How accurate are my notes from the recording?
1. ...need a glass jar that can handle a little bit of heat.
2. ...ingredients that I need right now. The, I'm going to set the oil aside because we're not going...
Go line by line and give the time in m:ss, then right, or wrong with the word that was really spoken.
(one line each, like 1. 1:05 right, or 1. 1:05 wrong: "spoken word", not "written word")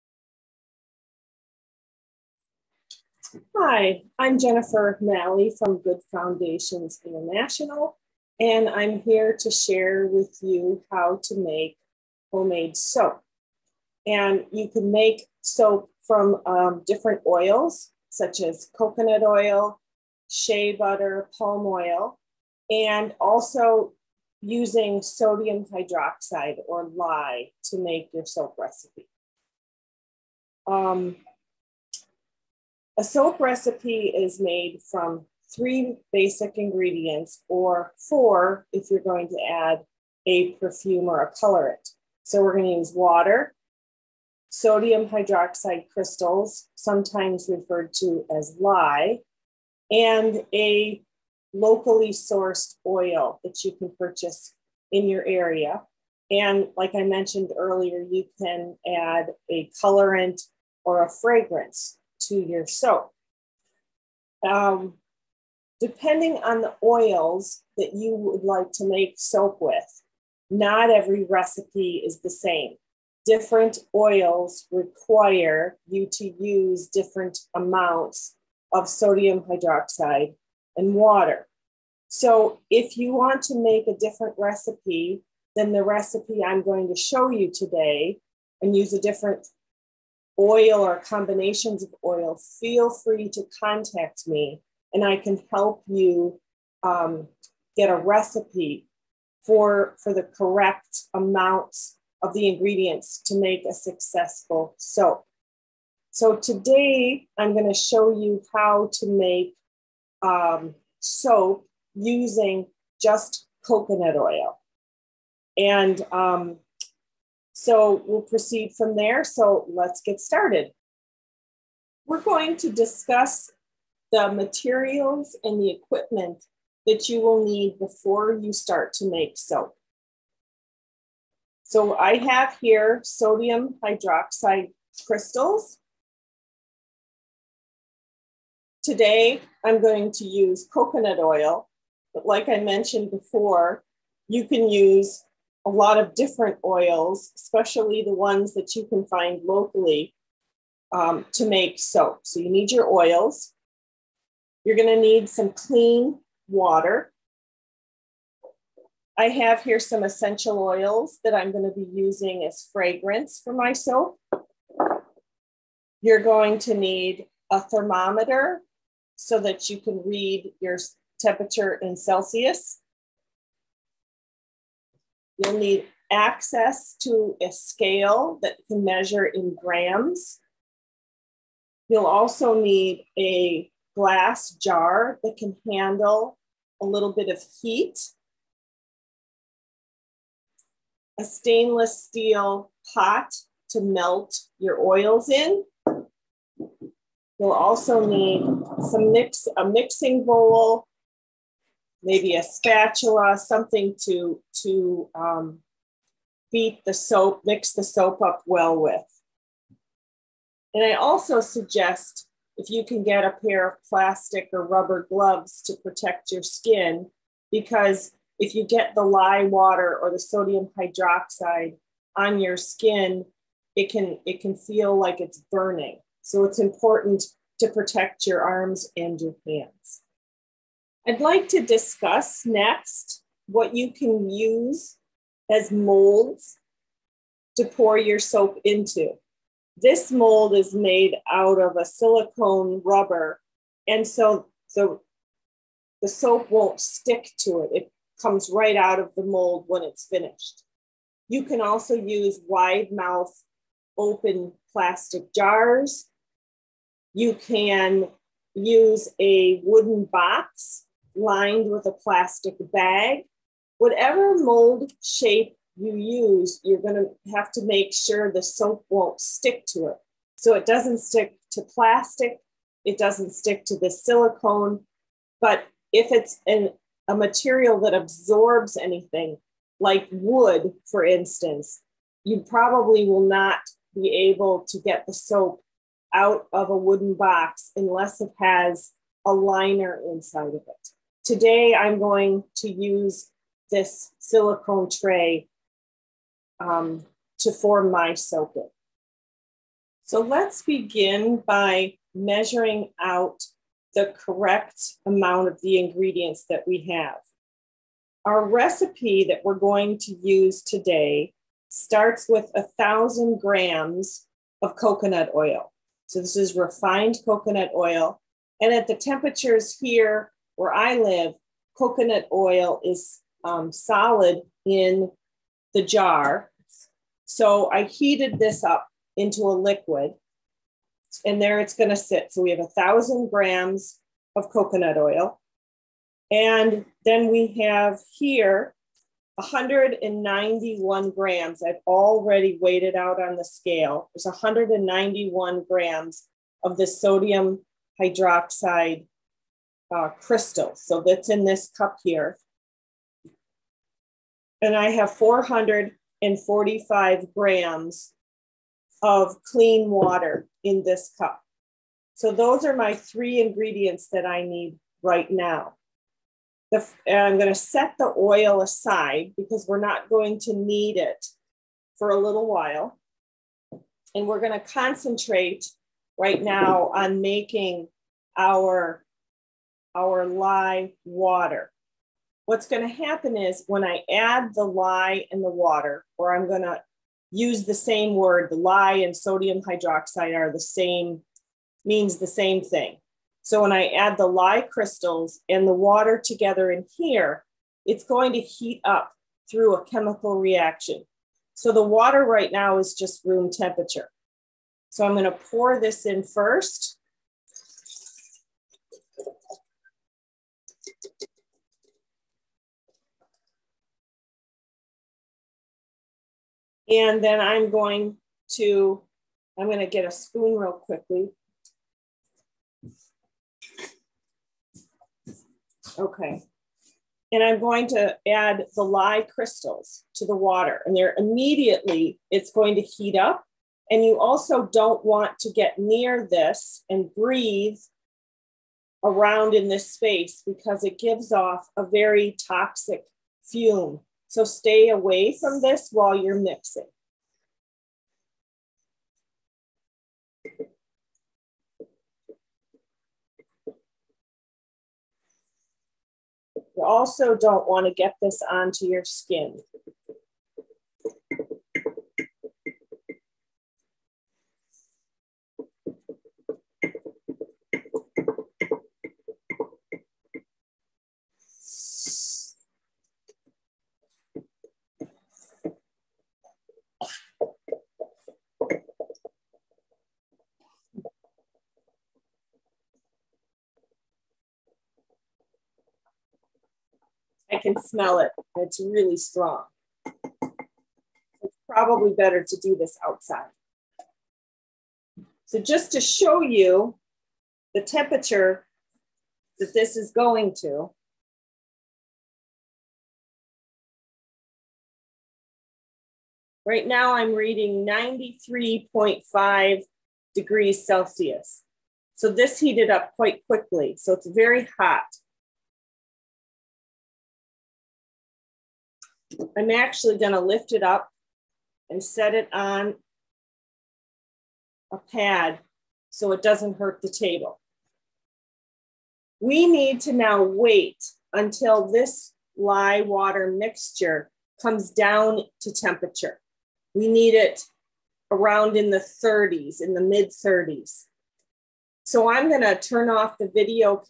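1. 3:02 right
2. 6:03 right.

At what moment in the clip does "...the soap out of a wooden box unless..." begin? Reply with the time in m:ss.
4:45.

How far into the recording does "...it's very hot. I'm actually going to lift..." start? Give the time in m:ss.
8:34.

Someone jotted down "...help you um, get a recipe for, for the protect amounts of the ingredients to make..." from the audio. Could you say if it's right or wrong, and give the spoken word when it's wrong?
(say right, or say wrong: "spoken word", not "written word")
wrong: "correct", not "protect".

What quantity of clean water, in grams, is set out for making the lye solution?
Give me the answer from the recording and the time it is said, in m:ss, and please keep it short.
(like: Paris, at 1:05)
445 grams, at 5:55.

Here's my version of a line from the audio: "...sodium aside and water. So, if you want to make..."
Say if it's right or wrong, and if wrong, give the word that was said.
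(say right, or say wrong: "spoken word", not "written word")
wrong: "hydroxide", not "aside".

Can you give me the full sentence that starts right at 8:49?
We need to now wait until this lye water mixture comes down to temperature.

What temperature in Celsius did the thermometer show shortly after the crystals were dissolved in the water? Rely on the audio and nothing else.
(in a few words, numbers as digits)
93.5 degrees Celsius.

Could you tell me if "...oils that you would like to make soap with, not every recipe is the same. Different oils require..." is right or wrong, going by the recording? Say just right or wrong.
right.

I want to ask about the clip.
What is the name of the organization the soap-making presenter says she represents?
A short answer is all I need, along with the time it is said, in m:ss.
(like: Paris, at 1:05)
Good Foundations International, at 0:05.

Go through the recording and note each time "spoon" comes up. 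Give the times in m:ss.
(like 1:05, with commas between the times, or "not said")
7:00.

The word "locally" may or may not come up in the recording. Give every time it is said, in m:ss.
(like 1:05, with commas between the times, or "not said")
0:51, 2:29.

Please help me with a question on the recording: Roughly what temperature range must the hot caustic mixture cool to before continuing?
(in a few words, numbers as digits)
mid 30s.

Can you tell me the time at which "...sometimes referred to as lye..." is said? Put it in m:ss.
0:46.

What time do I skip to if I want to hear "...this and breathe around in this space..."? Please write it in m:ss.
7:16.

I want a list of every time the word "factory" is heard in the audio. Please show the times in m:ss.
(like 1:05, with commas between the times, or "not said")
not said.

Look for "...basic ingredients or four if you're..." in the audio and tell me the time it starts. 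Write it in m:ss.
0:36.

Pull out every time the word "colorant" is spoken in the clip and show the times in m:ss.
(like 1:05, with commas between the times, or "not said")
0:41, 0:59.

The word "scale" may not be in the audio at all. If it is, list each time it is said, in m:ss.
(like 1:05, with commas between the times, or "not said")
2:57, 5:43.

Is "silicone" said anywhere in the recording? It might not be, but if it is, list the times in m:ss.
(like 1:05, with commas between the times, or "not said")
4:01, 4:33, 4:54.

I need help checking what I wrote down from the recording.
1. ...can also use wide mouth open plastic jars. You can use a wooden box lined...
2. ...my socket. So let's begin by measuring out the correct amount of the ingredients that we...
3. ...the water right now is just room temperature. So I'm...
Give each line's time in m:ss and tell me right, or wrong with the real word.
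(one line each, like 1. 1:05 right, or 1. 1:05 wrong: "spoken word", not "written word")
1. 4:11 right
2. 4:57 right
3. 6:41 right.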